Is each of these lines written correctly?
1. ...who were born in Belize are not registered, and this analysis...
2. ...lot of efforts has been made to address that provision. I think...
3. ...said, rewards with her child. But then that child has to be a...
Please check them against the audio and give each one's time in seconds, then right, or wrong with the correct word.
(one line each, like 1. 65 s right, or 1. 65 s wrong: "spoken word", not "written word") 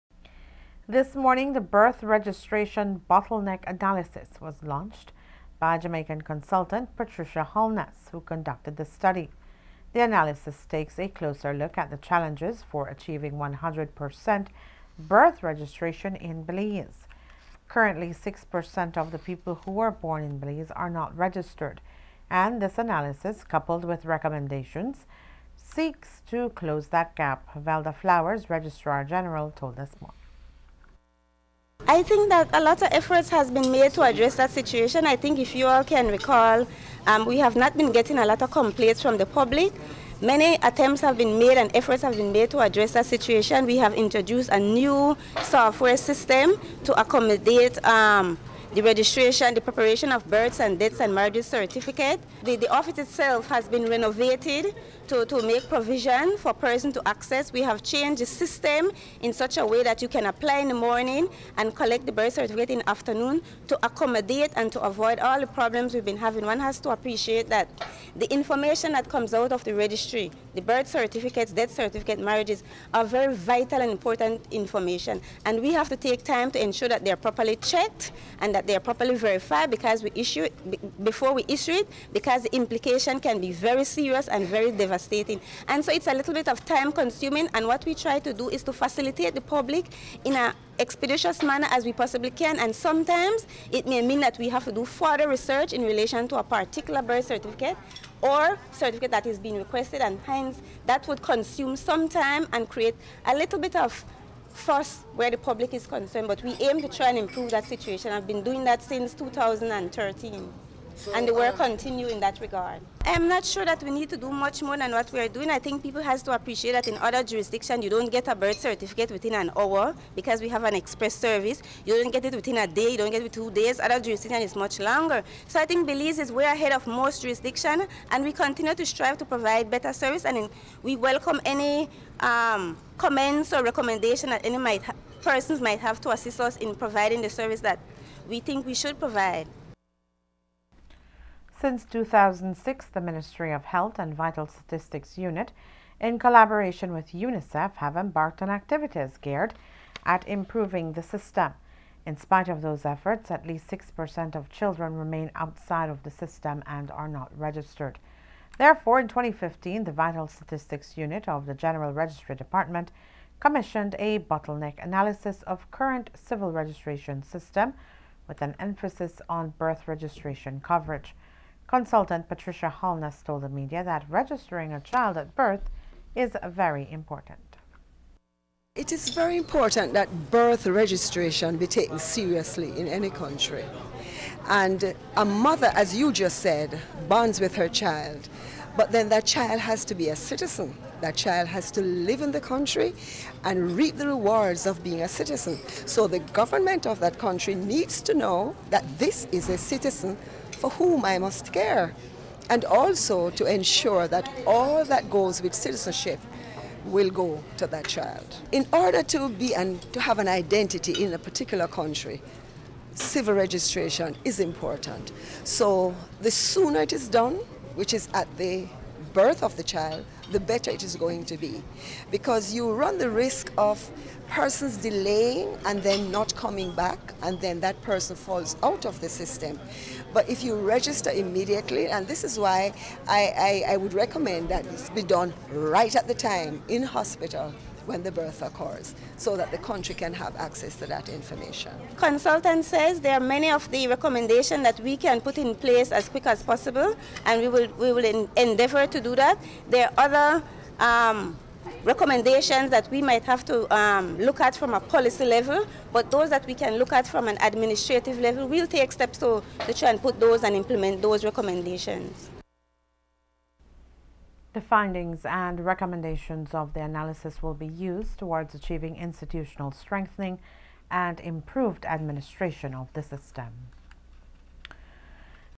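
1. 19 s right
2. 32 s wrong: "situation", not "provision"
3. 186 s wrong: "bonds", not "rewards".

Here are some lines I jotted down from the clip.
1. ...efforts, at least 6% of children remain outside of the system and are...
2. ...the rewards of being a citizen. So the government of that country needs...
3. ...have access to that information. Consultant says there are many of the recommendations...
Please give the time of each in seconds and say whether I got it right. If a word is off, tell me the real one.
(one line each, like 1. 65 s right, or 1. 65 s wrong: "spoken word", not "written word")
1. 152 s right
2. 193 s right
3. 240 s right.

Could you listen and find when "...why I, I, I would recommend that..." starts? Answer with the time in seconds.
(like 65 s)
232 s.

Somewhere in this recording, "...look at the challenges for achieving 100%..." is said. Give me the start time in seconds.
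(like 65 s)
11 s.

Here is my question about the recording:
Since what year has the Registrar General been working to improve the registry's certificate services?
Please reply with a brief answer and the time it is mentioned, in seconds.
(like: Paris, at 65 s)
2013, at 109 s.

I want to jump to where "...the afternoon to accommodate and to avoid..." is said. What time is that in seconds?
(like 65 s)
62 s.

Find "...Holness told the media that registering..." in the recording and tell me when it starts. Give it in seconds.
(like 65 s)
172 s.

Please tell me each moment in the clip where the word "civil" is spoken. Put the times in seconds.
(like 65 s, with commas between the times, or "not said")
166 s, 212 s.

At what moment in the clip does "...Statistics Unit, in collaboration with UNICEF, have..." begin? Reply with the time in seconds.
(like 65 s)
144 s.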